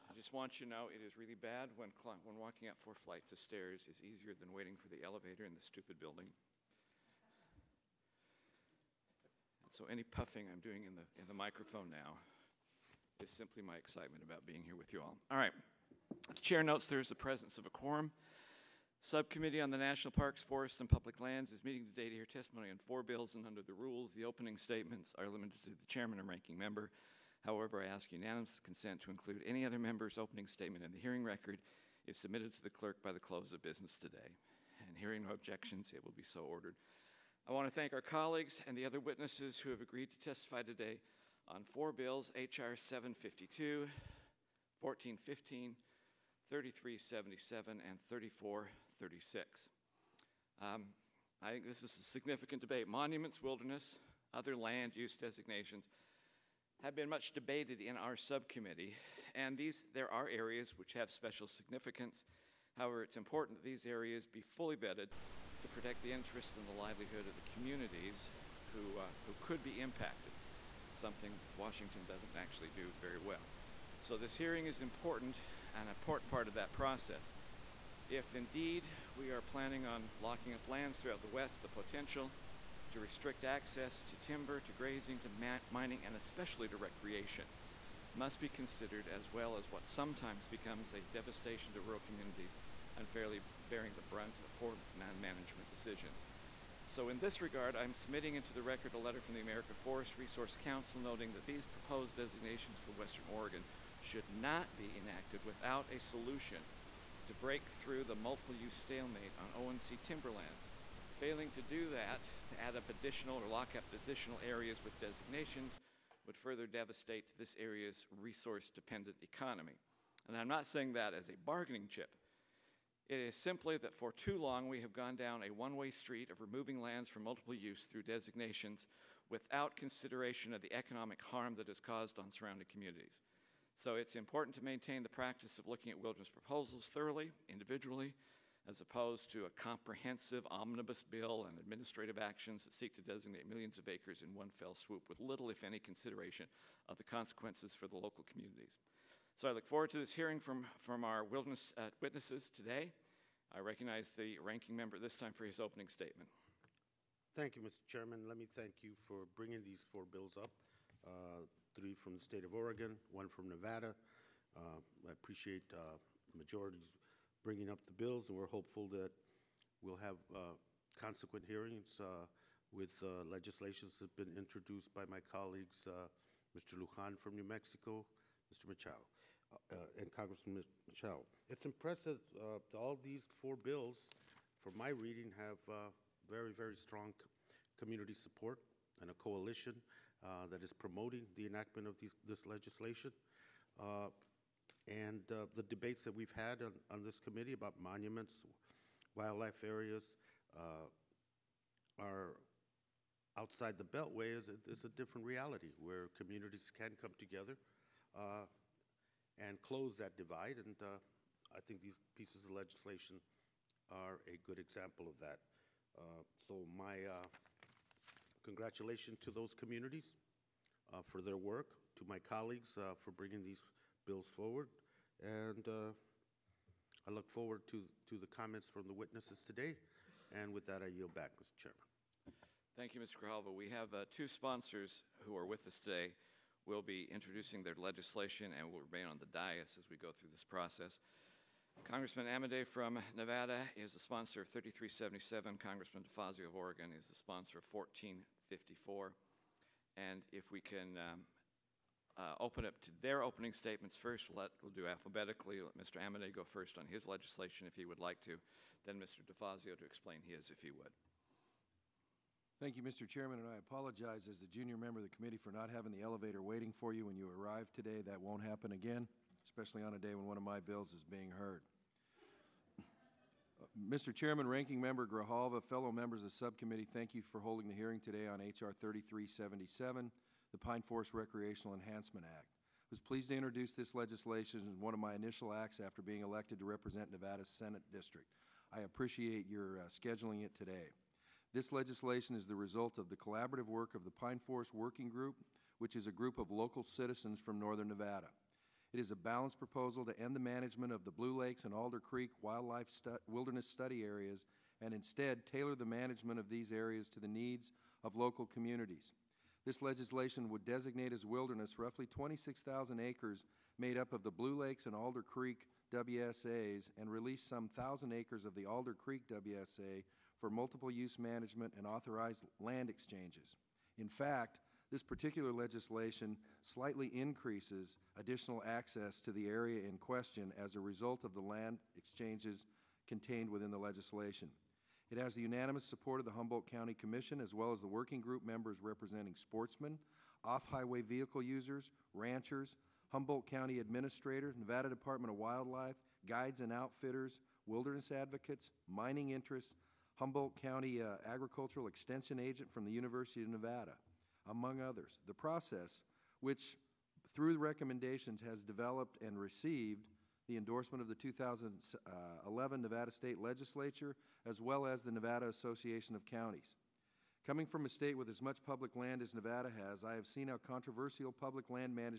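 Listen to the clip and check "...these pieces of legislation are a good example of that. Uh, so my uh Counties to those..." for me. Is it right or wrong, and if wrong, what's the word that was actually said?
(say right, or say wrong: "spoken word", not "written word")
wrong: "Congratulations", not "Counties".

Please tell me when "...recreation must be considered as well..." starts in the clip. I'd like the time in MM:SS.
01:26.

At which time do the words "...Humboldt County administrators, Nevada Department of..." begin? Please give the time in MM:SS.
05:43.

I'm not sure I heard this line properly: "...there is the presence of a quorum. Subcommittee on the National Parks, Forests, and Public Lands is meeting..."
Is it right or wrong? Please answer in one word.
right.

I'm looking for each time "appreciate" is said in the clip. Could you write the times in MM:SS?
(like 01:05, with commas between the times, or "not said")
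02:45, 04:48.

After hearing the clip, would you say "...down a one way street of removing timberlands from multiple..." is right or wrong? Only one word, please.
wrong.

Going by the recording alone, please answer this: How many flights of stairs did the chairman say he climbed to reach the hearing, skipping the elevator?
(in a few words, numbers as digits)
4.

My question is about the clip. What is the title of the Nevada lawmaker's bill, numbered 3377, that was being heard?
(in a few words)
Pine Forest Recreational Enhancement Act.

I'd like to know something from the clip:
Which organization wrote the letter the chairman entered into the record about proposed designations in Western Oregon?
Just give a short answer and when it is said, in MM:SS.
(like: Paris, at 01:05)
America Forest Resource Council, at 01:39.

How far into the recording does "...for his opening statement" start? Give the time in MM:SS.
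02:35.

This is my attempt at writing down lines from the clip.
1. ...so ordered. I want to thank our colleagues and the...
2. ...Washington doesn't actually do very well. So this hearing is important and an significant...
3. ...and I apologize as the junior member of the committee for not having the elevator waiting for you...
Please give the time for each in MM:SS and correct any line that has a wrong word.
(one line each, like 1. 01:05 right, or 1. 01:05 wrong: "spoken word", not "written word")
1. 00:36 right
2. 01:11 wrong: "important", not "significant"
3. 04:23 right.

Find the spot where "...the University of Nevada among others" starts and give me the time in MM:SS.
05:52.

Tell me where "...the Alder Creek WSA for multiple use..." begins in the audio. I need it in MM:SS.
05:18.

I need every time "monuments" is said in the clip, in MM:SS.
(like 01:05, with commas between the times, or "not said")
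00:52, 03:17.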